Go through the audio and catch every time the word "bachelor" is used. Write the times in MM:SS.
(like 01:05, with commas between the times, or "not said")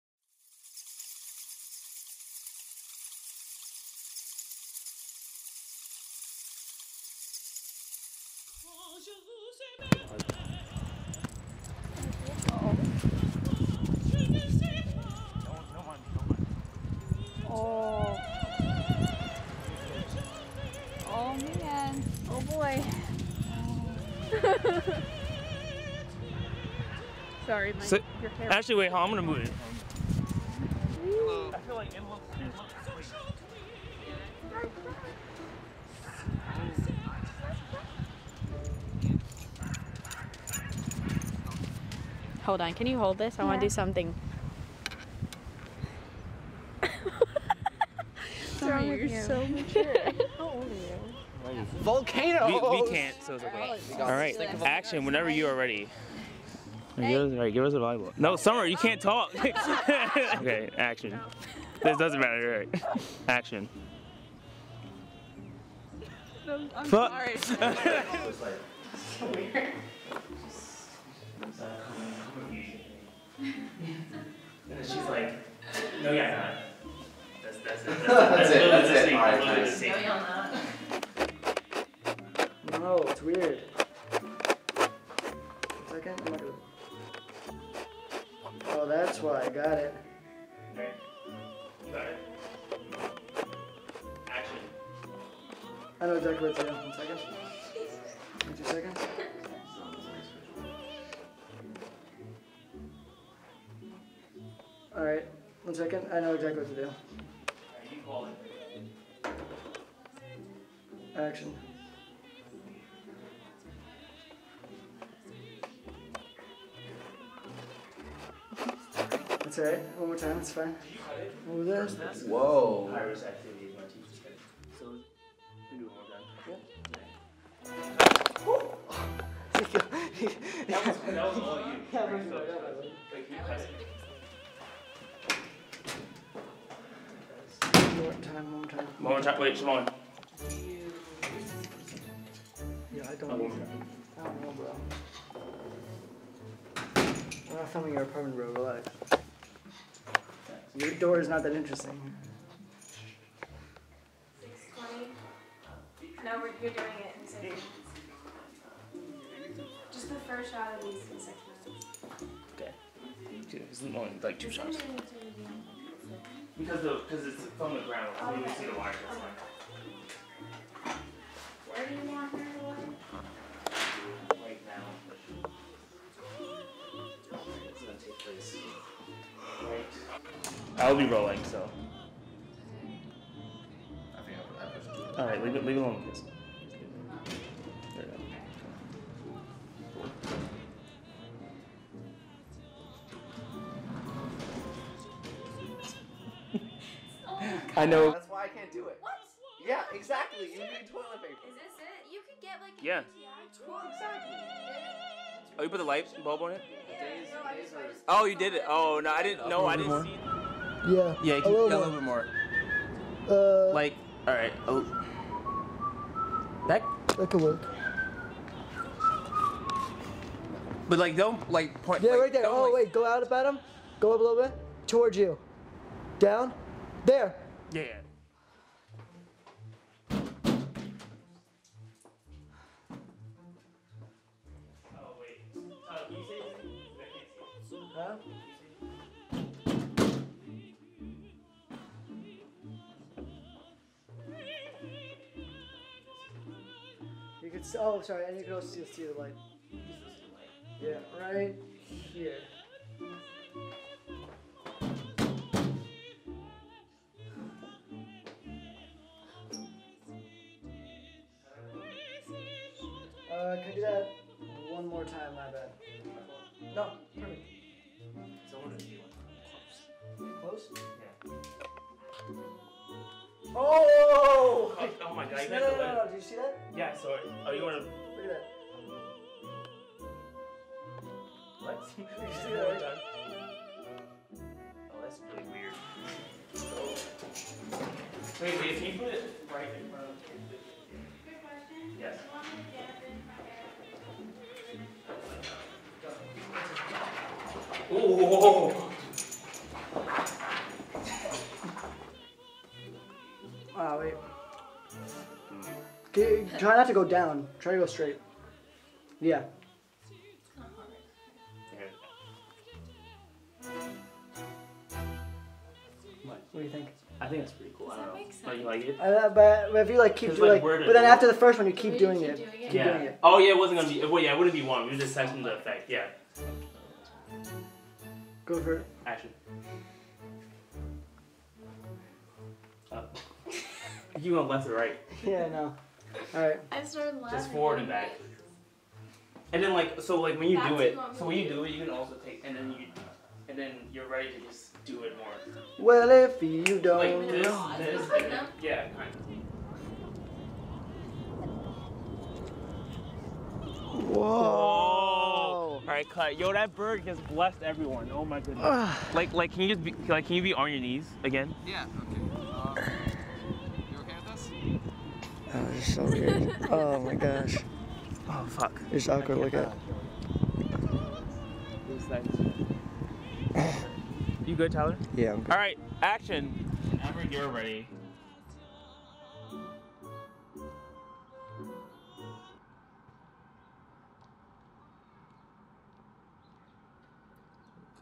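not said.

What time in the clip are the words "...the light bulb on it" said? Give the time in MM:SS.
03:25.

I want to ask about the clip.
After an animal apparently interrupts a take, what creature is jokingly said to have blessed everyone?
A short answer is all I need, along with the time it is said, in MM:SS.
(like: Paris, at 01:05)
bird, at 05:56.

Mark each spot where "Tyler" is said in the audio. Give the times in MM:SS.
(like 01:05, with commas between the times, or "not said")
06:14.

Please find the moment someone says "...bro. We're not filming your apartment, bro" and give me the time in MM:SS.
02:24.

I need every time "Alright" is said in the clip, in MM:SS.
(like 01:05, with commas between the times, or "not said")
01:44.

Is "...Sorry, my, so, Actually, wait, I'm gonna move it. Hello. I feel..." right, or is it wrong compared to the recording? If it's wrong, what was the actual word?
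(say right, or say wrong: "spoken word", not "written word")
right.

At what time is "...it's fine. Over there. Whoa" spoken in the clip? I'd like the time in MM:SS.
02:00.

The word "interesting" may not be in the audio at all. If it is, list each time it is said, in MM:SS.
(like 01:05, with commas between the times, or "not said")
02:31.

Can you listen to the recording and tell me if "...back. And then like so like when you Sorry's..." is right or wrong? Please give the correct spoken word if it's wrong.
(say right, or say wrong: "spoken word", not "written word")
wrong: "That", not "Sorry".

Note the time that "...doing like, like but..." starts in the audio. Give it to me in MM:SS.
05:20.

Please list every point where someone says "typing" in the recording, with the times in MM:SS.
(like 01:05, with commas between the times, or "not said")
not said.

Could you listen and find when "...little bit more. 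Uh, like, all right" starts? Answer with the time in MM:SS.
03:31.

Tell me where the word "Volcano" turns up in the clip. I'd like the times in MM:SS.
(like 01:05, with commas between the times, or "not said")
00:51.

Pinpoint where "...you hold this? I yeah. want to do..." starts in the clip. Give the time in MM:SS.
00:42.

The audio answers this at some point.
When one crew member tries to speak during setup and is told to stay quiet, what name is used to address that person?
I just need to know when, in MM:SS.
00:58.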